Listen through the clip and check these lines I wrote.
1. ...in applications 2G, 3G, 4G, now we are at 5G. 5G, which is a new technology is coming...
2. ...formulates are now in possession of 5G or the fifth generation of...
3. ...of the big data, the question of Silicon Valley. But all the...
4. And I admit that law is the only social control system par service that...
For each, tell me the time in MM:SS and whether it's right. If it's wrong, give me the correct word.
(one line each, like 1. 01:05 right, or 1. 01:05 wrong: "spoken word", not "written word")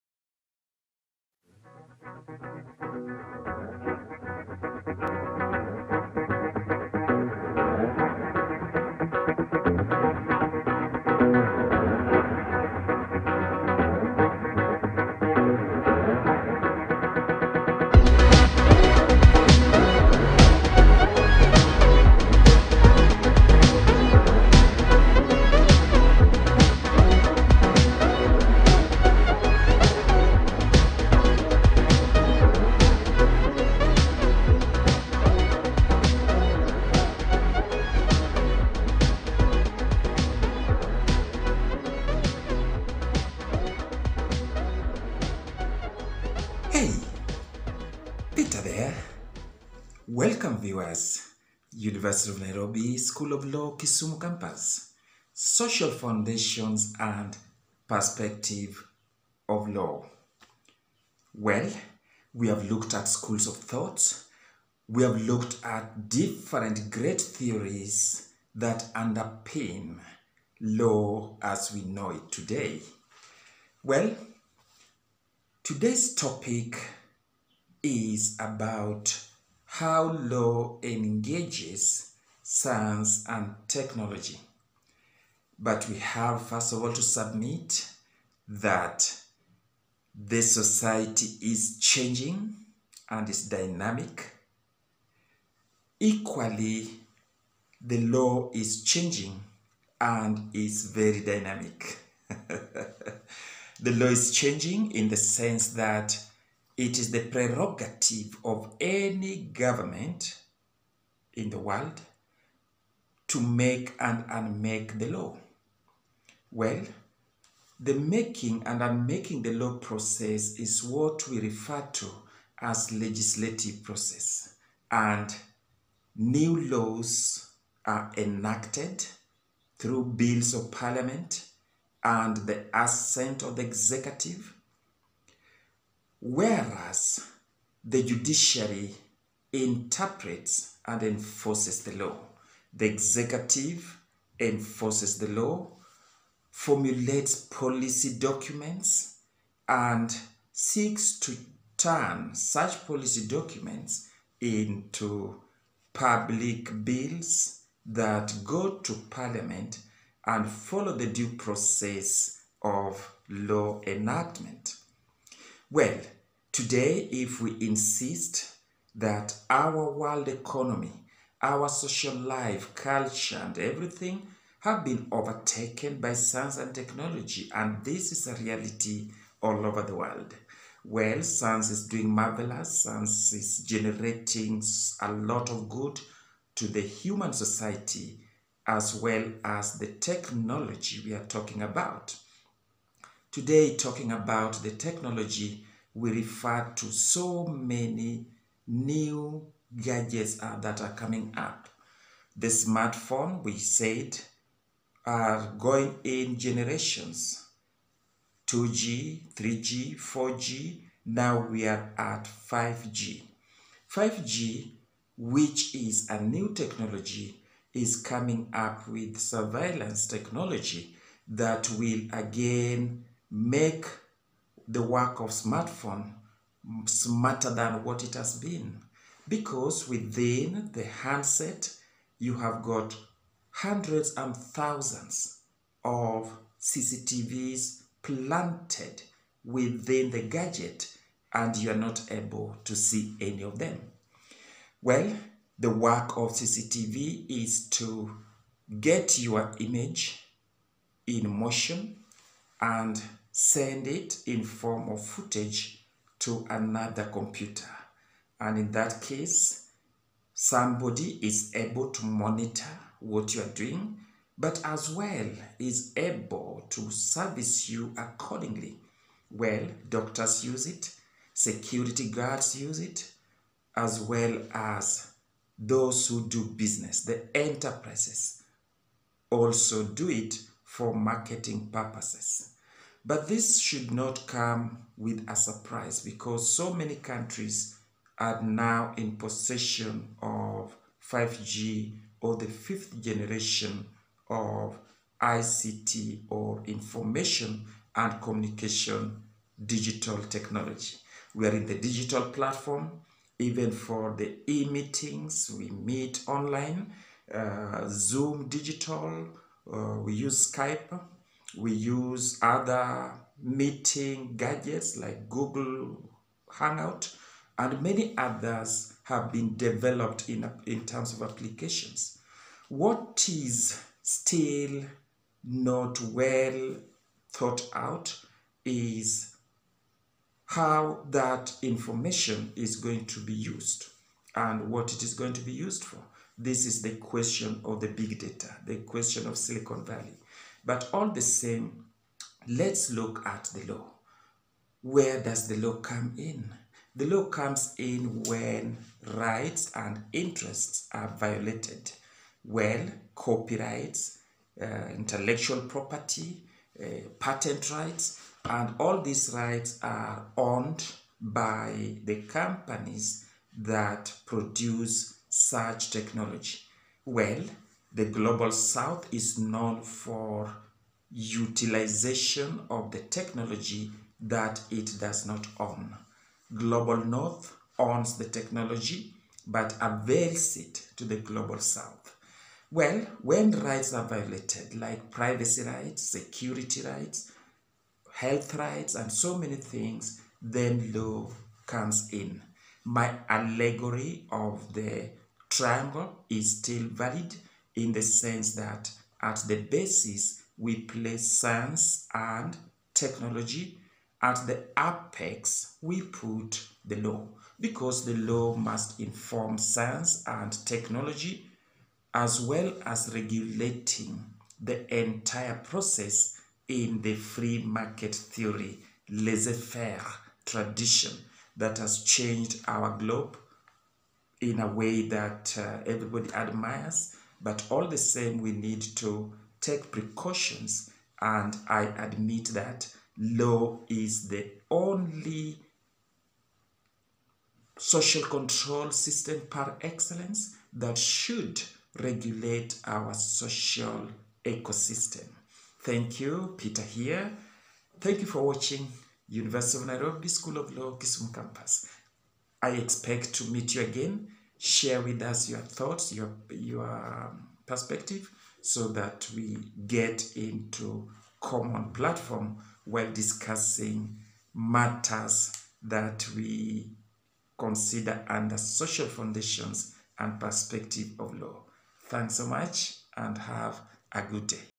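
1. 03:26 wrong: "generations", not "applications"
2. 04:46 wrong: "countries", not "formulates"
3. 05:37 right
4. 07:11 wrong: "excellence", not "service".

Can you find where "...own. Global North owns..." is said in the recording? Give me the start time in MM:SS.
06:15.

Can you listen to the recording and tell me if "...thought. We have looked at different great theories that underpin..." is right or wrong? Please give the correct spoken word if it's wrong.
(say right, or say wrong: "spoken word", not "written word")
right.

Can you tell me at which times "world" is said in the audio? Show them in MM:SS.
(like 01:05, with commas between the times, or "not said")
01:51, 02:49, 02:59.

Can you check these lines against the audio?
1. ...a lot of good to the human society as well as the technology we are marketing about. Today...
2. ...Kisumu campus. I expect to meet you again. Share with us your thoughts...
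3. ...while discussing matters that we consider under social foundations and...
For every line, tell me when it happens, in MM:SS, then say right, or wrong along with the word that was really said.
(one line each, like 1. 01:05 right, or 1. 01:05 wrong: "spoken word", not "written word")
1. 03:05 wrong: "talking", not "marketing"
2. 07:30 right
3. 07:42 right.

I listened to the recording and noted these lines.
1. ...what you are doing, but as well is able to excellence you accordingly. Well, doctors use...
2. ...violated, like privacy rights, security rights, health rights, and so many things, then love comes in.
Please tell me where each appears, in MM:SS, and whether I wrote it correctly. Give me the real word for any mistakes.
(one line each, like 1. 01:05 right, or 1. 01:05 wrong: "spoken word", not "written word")
1. 04:22 wrong: "service", not "excellence"
2. 06:24 right.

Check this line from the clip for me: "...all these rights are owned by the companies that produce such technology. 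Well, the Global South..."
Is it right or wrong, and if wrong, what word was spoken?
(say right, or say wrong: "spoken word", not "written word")
right.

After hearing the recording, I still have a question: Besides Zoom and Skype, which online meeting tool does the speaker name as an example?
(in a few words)
Google Hangout.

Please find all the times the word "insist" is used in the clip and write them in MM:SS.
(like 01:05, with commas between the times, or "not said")
02:47.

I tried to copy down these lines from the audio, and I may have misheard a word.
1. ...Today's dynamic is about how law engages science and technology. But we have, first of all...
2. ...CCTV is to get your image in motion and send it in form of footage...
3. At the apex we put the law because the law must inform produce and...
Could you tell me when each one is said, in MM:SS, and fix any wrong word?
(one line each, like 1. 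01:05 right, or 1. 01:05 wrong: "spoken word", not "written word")
1. 01:15 wrong: "topic", not "dynamic"
2. 04:06 right
3. 06:44 wrong: "science", not "produce".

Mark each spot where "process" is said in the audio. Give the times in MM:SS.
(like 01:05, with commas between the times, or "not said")
01:59, 02:03, 02:41, 06:55.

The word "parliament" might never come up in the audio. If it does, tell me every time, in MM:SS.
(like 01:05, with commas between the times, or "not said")
02:10, 02:39.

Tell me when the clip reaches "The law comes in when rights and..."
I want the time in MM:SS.
05:46.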